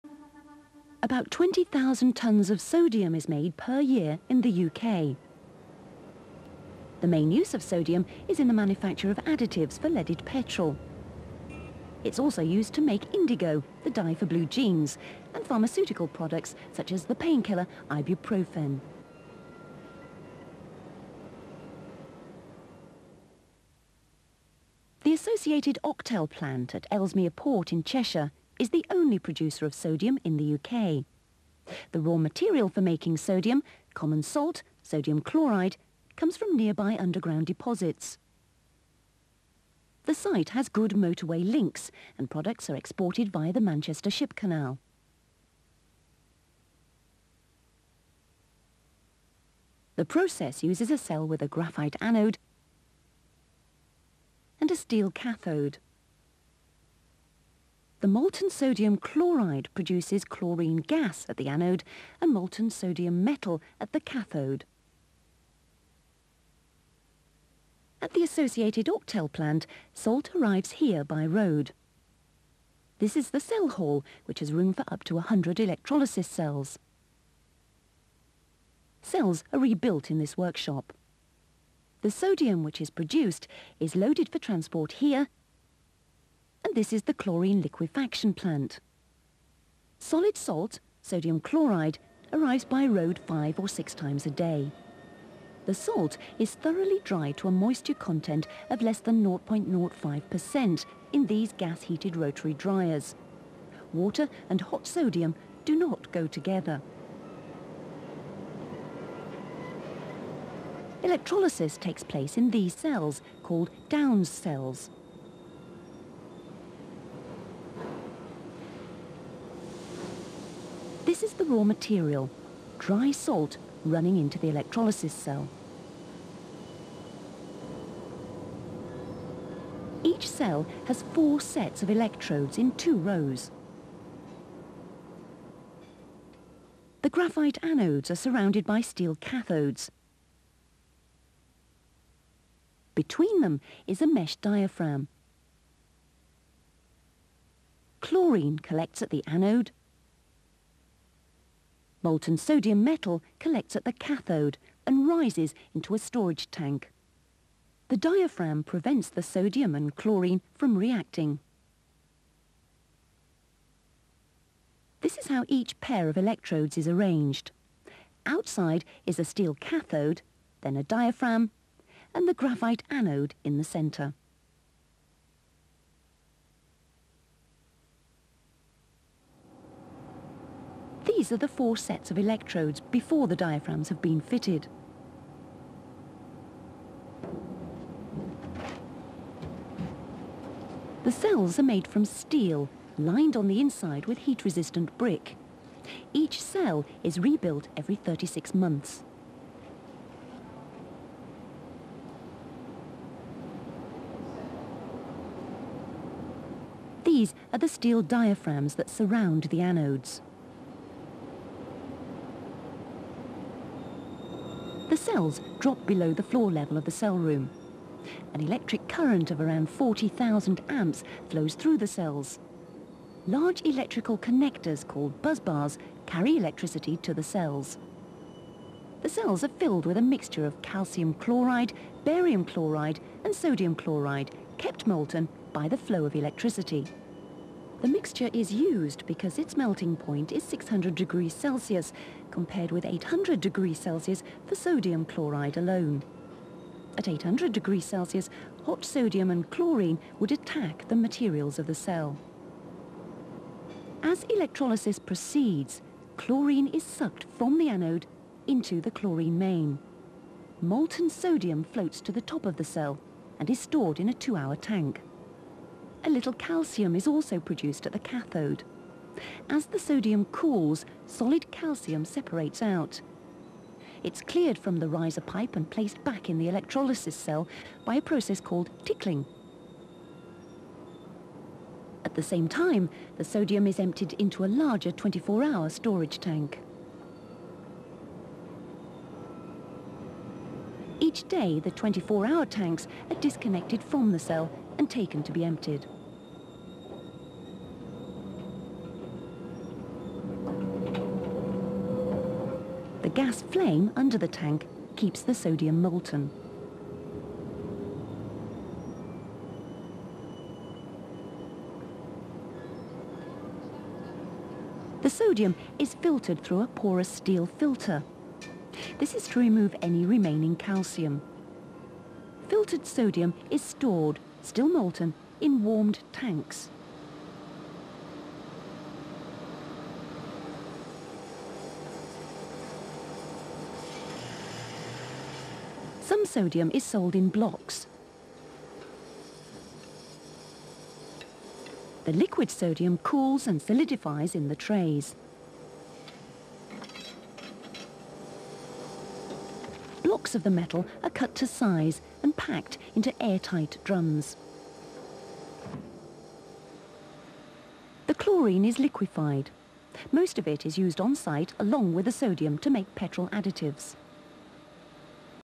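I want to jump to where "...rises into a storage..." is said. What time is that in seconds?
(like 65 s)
155 s.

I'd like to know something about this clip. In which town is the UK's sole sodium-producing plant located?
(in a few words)
Ellesmere Port.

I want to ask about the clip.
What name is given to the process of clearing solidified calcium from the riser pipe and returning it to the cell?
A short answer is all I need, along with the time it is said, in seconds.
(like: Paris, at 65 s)
tickling, at 278 s.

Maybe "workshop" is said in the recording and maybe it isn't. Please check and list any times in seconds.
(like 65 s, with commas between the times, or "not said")
80 s.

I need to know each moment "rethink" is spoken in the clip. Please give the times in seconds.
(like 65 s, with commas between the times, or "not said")
not said.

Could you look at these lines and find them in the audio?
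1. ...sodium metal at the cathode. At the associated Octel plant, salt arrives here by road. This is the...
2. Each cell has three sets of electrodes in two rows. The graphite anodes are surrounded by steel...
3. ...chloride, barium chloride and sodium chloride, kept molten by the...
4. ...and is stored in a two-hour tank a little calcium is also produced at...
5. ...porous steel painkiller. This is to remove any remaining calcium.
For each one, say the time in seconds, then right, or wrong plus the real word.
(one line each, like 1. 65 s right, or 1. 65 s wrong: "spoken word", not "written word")
1. 62 s right
2. 130 s wrong: "four", not "three"
3. 231 s right
4. 263 s right
5. 316 s wrong: "filter", not "painkiller".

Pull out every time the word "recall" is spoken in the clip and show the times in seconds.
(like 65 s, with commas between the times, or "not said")
not said.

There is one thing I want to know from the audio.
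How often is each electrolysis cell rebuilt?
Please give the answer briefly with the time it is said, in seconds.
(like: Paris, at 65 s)
every 36 months, at 197 s.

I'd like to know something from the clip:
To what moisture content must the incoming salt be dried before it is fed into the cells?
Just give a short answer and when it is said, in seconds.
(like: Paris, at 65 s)
less than 0.05%, at 98 s.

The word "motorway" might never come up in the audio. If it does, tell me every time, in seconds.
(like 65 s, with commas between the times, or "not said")
40 s.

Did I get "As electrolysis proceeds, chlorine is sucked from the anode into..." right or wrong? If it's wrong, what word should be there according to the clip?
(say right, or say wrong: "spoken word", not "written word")
right.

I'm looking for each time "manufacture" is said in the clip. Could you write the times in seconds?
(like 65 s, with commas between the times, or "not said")
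8 s.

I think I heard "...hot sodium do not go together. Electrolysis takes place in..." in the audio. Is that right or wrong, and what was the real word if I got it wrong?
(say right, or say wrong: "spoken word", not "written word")
right.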